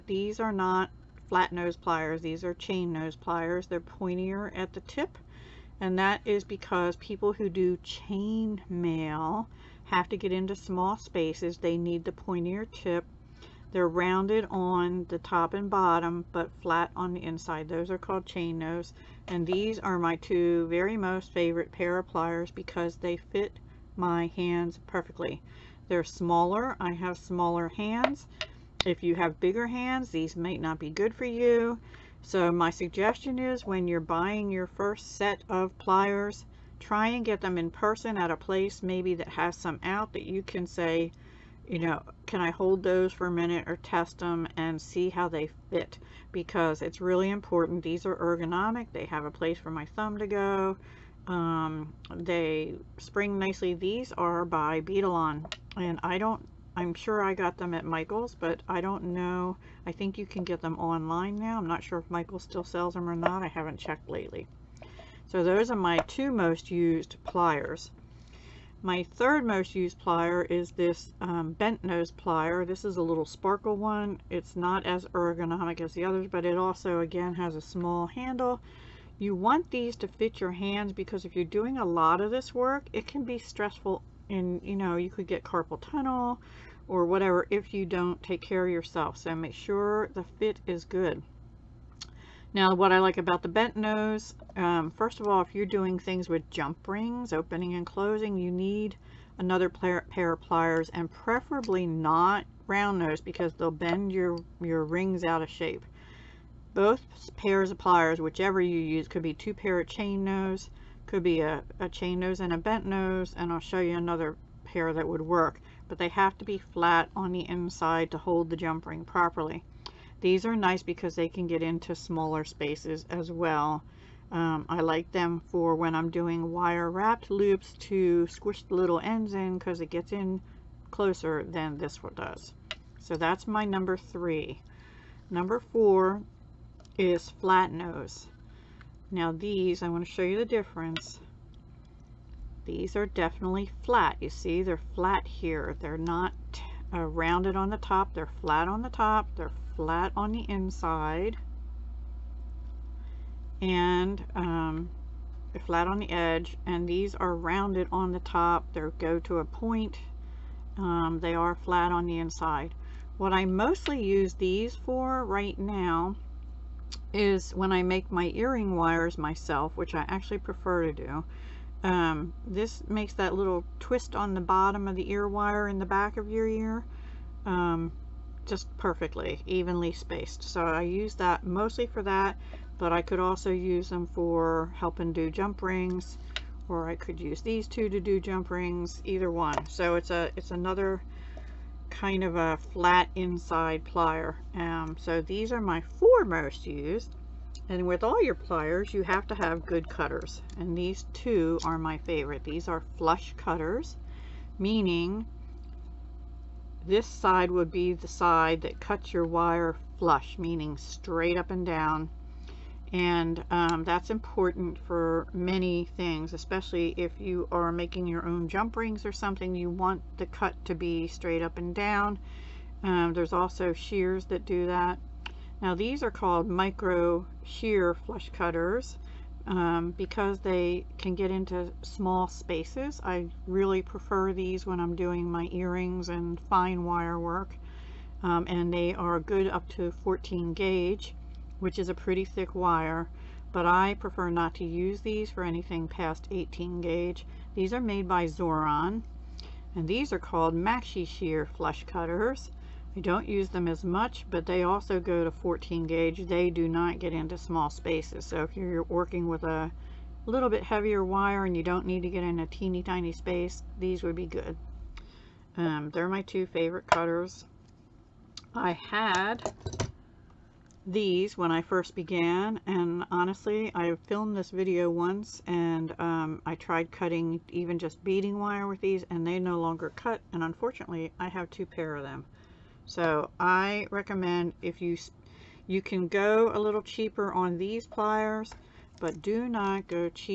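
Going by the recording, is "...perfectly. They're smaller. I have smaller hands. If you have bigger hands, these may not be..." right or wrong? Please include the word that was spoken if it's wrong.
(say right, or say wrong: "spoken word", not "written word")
right.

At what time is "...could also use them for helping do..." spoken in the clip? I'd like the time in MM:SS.
03:03.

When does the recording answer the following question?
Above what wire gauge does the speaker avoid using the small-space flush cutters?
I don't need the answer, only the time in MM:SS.
04:06.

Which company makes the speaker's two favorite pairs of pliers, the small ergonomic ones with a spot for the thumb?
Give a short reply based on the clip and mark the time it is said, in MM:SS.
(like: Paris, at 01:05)
Beadalon, at 00:54.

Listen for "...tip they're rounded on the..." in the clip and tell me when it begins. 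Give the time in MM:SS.
00:12.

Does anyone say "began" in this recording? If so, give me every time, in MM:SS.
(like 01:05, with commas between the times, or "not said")
04:31.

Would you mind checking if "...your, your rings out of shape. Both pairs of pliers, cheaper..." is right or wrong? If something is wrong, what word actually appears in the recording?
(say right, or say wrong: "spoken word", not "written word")
wrong: "whichever", not "cheaper".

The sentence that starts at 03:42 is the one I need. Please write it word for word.
Um, there's also shears that do that.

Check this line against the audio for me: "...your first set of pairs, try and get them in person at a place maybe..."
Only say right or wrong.
wrong.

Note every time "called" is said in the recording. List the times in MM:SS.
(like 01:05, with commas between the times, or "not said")
00:17, 03:46, 04:10.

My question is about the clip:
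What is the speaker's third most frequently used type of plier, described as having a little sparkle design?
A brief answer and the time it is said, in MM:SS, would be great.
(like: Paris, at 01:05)
Bent nose plier, at 01:11.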